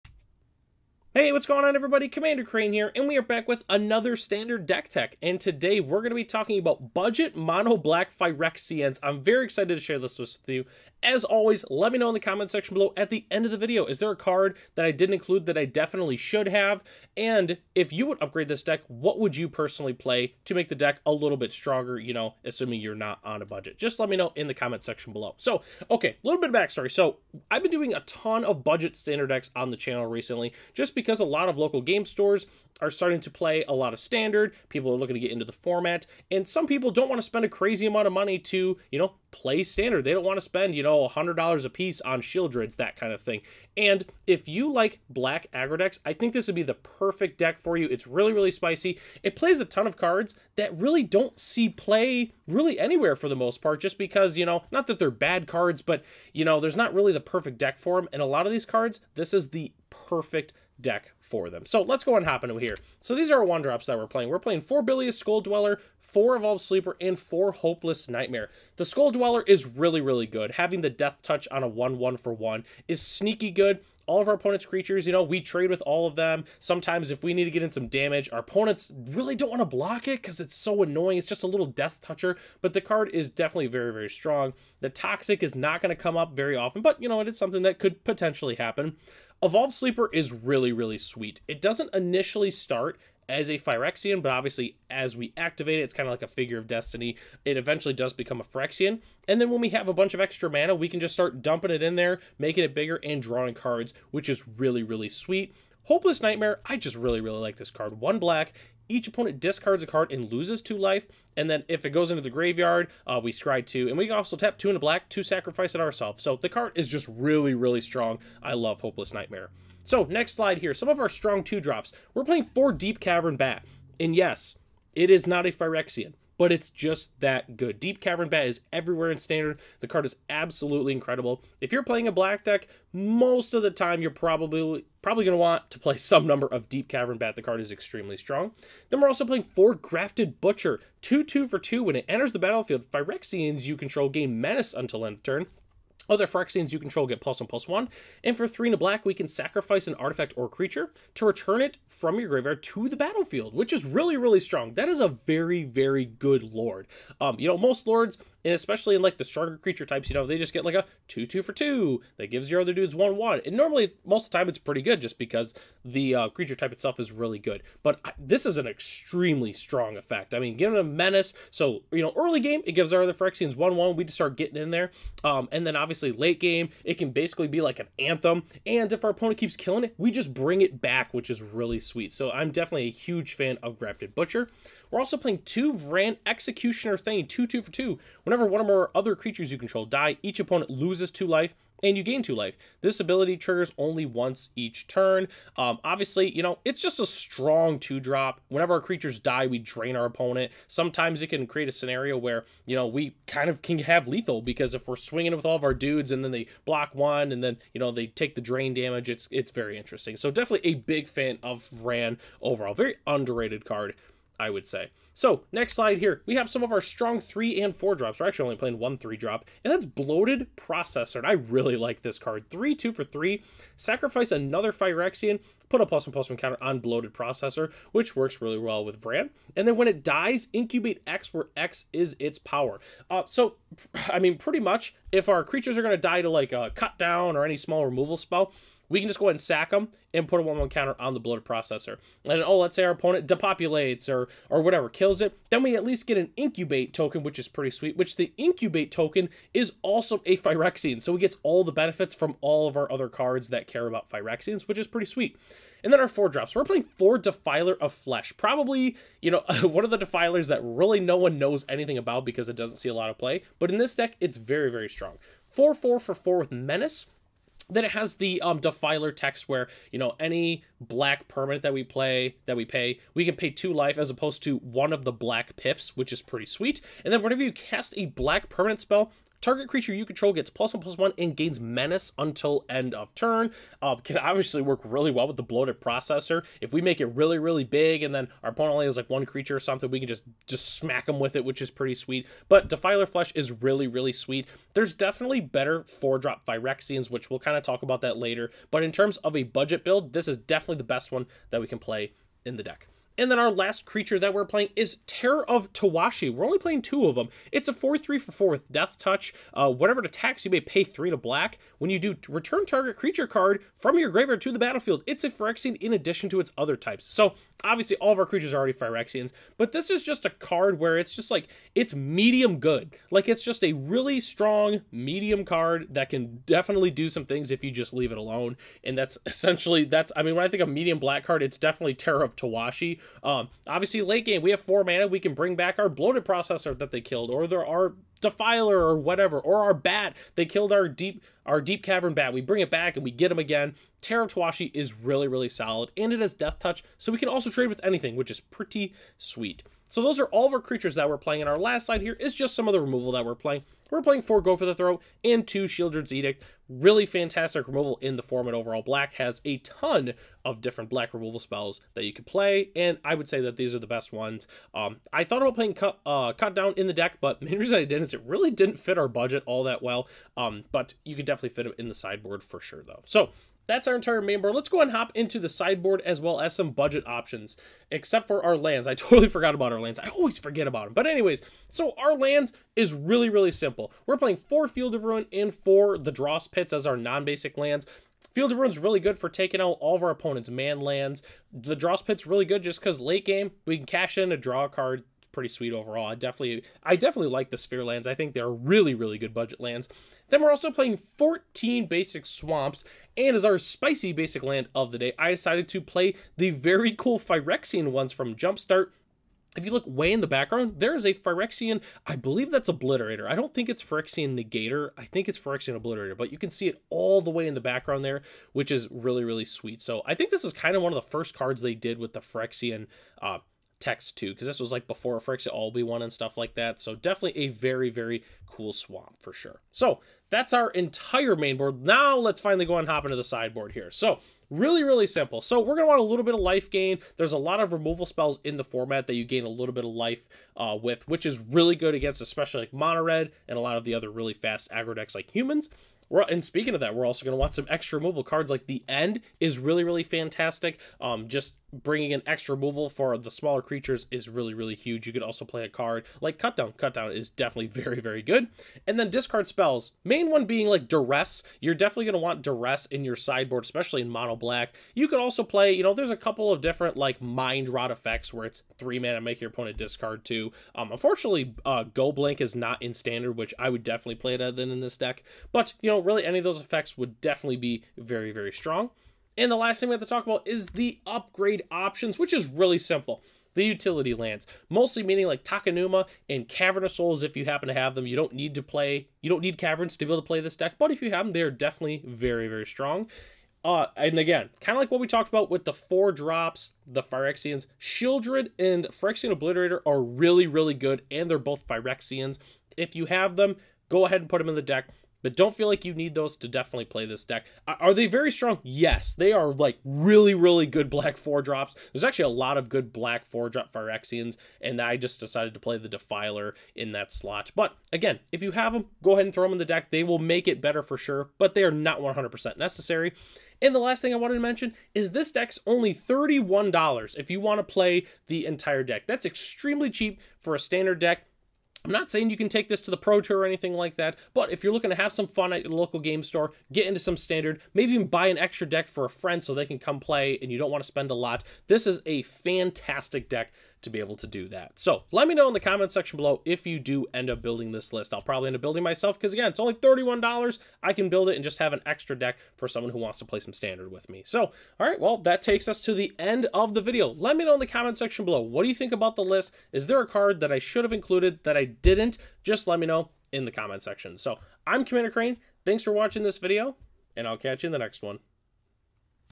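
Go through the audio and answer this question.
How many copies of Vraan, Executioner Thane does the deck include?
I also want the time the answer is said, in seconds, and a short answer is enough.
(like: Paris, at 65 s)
2, at 185 s.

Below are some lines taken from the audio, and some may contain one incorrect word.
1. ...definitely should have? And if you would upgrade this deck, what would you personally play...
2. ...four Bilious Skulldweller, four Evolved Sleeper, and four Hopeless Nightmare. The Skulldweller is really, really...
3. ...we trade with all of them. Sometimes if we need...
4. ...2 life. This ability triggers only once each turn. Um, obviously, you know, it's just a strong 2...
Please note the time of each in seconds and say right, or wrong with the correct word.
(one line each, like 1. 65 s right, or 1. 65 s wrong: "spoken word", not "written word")
1. 15 s right
2. 64 s right
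3. 75 s right
4. 192 s right.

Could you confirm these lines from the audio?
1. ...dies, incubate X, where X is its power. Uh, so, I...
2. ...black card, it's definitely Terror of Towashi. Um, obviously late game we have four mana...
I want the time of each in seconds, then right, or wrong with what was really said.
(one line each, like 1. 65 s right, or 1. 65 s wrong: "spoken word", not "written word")
1. 230 s right
2. 330 s right.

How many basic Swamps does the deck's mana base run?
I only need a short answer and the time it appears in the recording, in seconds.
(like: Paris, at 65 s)
14, at 401 s.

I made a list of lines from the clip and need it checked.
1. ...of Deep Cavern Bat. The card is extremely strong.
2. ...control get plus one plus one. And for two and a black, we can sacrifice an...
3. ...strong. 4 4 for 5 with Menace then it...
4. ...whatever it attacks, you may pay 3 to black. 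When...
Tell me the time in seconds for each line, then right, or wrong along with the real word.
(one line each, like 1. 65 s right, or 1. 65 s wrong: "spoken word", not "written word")
1. 136 s right
2. 146 s wrong: "three", not "two"
3. 264 s wrong: "4", not "5"
4. 309 s right.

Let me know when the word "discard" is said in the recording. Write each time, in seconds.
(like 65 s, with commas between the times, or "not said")
109 s, 459 s, 469 s.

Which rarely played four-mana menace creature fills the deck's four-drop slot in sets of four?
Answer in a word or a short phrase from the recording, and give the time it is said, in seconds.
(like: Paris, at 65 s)
Defiler of Flesh, at 257 s.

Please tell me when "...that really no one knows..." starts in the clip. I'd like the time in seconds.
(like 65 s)
260 s.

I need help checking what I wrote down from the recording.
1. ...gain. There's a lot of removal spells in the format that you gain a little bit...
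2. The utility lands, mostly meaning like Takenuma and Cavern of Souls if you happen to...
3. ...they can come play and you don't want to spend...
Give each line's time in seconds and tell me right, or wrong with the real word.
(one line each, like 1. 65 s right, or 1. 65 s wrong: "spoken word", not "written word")
1. 436 s right
2. 483 s right
3. 539 s right.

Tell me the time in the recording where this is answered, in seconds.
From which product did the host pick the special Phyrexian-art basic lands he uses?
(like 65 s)
408 s.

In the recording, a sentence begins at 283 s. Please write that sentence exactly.
Uh, can obviously work really well with the bloated processor.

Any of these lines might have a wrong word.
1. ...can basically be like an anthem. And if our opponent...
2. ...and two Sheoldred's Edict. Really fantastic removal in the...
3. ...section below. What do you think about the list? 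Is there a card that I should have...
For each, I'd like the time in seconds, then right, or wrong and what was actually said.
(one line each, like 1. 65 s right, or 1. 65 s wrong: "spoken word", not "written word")
1. 176 s right
2. 355 s right
3. 557 s right.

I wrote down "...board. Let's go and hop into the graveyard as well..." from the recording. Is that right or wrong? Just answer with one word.
wrong.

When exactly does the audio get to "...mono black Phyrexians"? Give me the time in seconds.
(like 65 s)
7 s.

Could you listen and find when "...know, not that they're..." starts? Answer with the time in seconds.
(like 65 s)
54 s.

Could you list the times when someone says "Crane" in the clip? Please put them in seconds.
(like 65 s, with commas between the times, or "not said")
2 s, 565 s.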